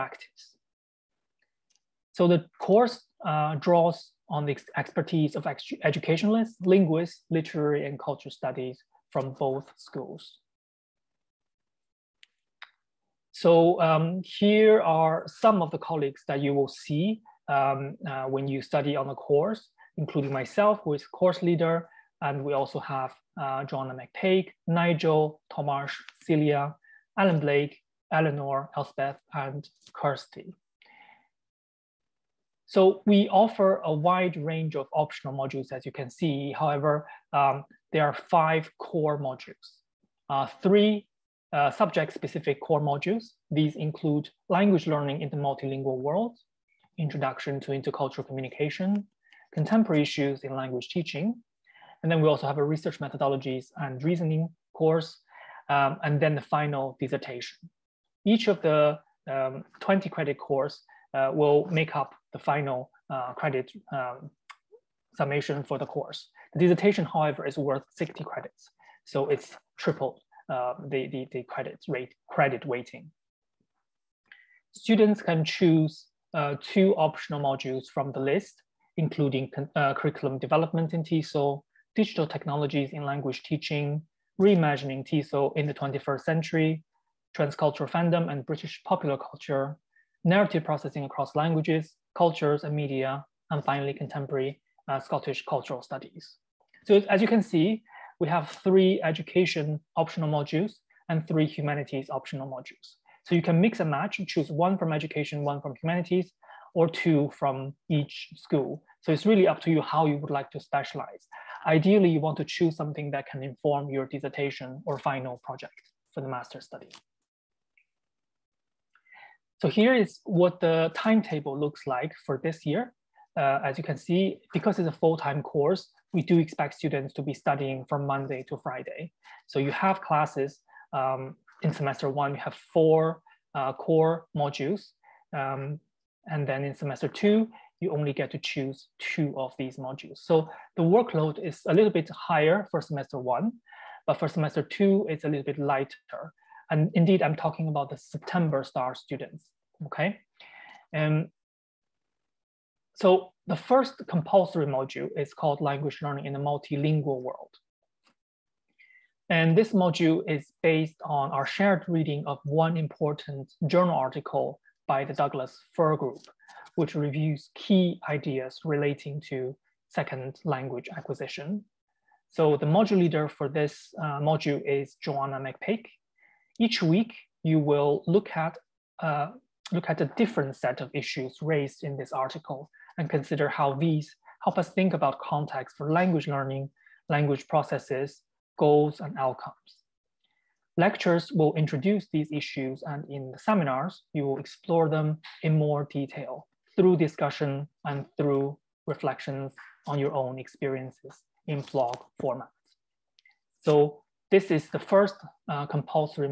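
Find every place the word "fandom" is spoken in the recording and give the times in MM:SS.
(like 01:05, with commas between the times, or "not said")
01:27.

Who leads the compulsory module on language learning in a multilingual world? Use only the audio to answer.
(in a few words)
Joanna McPake.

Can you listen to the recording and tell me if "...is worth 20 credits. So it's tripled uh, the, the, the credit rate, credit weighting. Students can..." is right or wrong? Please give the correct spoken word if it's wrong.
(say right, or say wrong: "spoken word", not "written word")
wrong: "60", not "20".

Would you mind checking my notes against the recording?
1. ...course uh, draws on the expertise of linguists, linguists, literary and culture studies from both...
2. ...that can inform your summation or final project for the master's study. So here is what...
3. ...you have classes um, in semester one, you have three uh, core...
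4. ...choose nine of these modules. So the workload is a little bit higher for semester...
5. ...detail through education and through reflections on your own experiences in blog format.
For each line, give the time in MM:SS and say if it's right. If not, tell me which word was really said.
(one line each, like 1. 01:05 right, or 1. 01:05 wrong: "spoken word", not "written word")
1. 00:02 wrong: "educationalists", not "linguists"
2. 01:53 wrong: "dissertation", not "summation"
3. 02:09 wrong: "four", not "three"
4. 02:18 wrong: "two", not "nine"
5. 03:15 wrong: "discussion", not "education".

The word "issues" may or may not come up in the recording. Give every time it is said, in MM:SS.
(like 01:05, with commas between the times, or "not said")
00:50, 03:00, 03:12.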